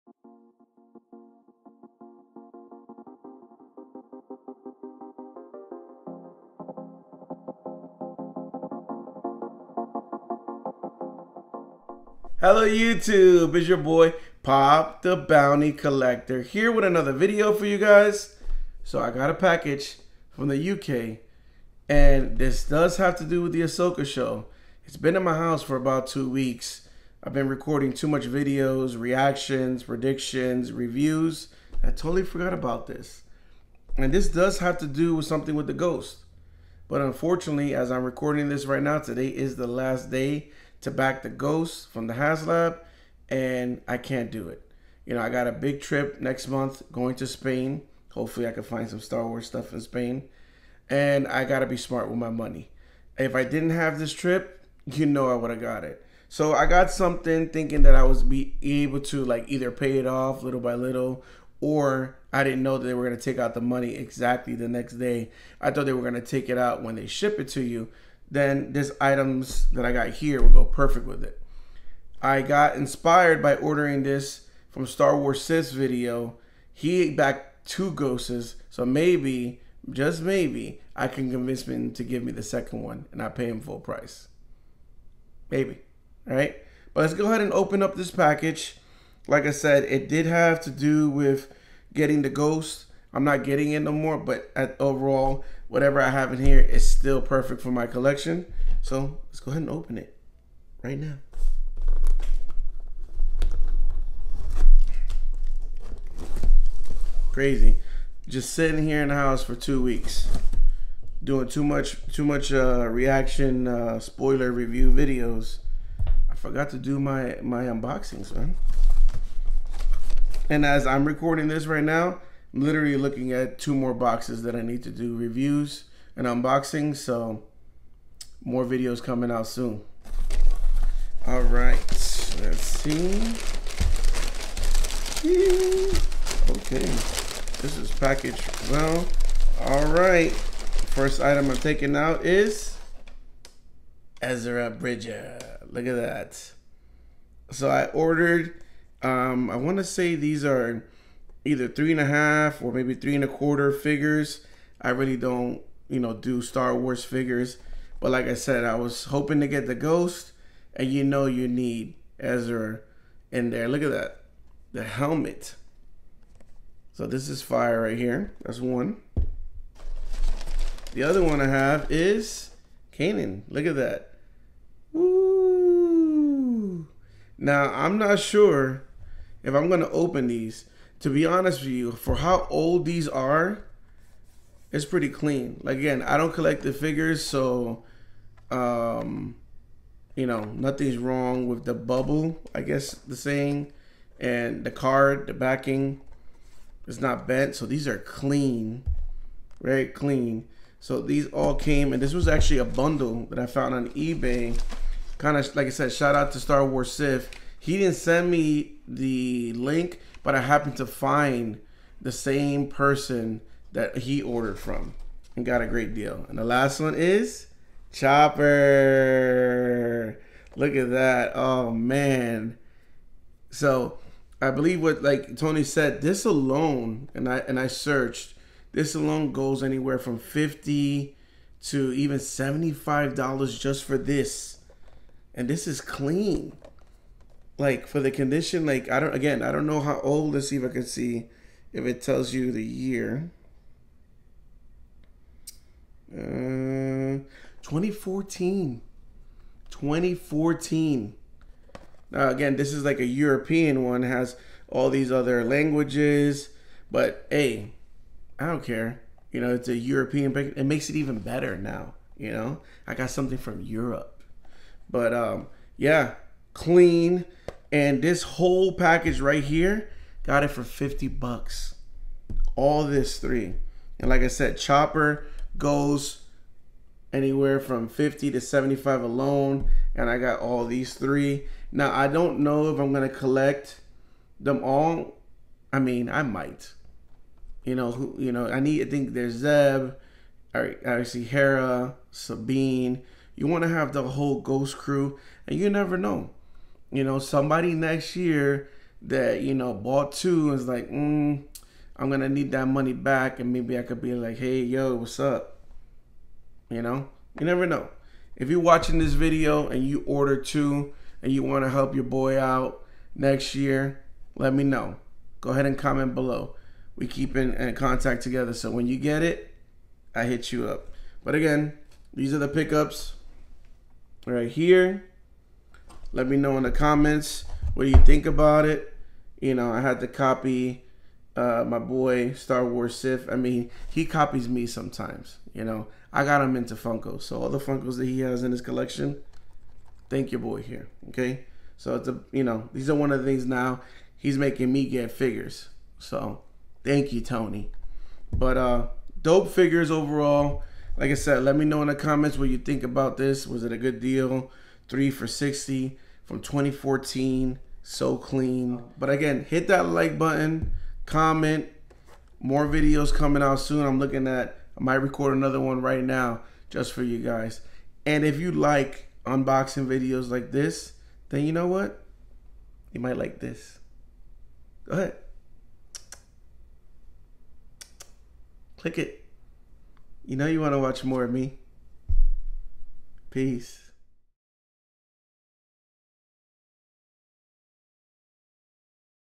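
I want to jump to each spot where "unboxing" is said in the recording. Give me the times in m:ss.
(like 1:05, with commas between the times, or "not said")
1:57, 2:06, 6:09.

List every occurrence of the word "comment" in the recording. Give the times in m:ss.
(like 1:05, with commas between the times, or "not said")
5:15, 5:26, 5:51, 6:01.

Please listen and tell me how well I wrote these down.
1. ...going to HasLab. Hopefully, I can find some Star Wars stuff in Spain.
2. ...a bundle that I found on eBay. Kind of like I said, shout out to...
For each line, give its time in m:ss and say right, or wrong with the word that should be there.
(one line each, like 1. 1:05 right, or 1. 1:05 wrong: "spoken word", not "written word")
1. 0:46 wrong: "Spain", not "HasLab"
2. 3:22 right.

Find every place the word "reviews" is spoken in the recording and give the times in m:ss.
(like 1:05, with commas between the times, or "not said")
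0:30, 1:54, 2:05.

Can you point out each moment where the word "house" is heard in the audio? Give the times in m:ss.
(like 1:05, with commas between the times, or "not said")
0:25, 1:49.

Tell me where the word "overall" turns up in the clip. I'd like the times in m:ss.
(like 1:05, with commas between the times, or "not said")
1:34, 5:49.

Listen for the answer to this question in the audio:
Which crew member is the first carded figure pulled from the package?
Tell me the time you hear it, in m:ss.
2:24.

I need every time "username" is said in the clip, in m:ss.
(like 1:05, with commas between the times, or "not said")
not said.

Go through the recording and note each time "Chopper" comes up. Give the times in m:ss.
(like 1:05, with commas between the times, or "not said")
3:37, 4:34.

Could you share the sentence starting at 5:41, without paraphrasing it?
Okay, so it's a you know these are one of the things now he's making me get figures.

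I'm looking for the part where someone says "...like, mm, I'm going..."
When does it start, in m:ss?
5:00.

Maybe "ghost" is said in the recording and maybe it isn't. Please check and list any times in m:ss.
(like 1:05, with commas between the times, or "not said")
0:35, 0:41, 1:17, 1:32, 2:39, 4:54.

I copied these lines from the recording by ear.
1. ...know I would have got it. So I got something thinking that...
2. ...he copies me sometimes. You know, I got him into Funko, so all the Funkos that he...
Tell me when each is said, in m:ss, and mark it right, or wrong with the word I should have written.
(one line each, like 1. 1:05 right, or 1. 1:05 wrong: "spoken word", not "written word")
1. 0:55 right
2. 5:33 right.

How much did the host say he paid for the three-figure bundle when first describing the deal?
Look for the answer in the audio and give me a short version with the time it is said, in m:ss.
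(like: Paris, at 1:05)
$50, at 4:30.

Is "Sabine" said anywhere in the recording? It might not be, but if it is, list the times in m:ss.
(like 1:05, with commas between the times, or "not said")
4:52.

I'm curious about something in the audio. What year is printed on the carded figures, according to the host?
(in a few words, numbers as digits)
2014.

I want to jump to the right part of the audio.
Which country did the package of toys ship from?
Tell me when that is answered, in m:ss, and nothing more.
0:20.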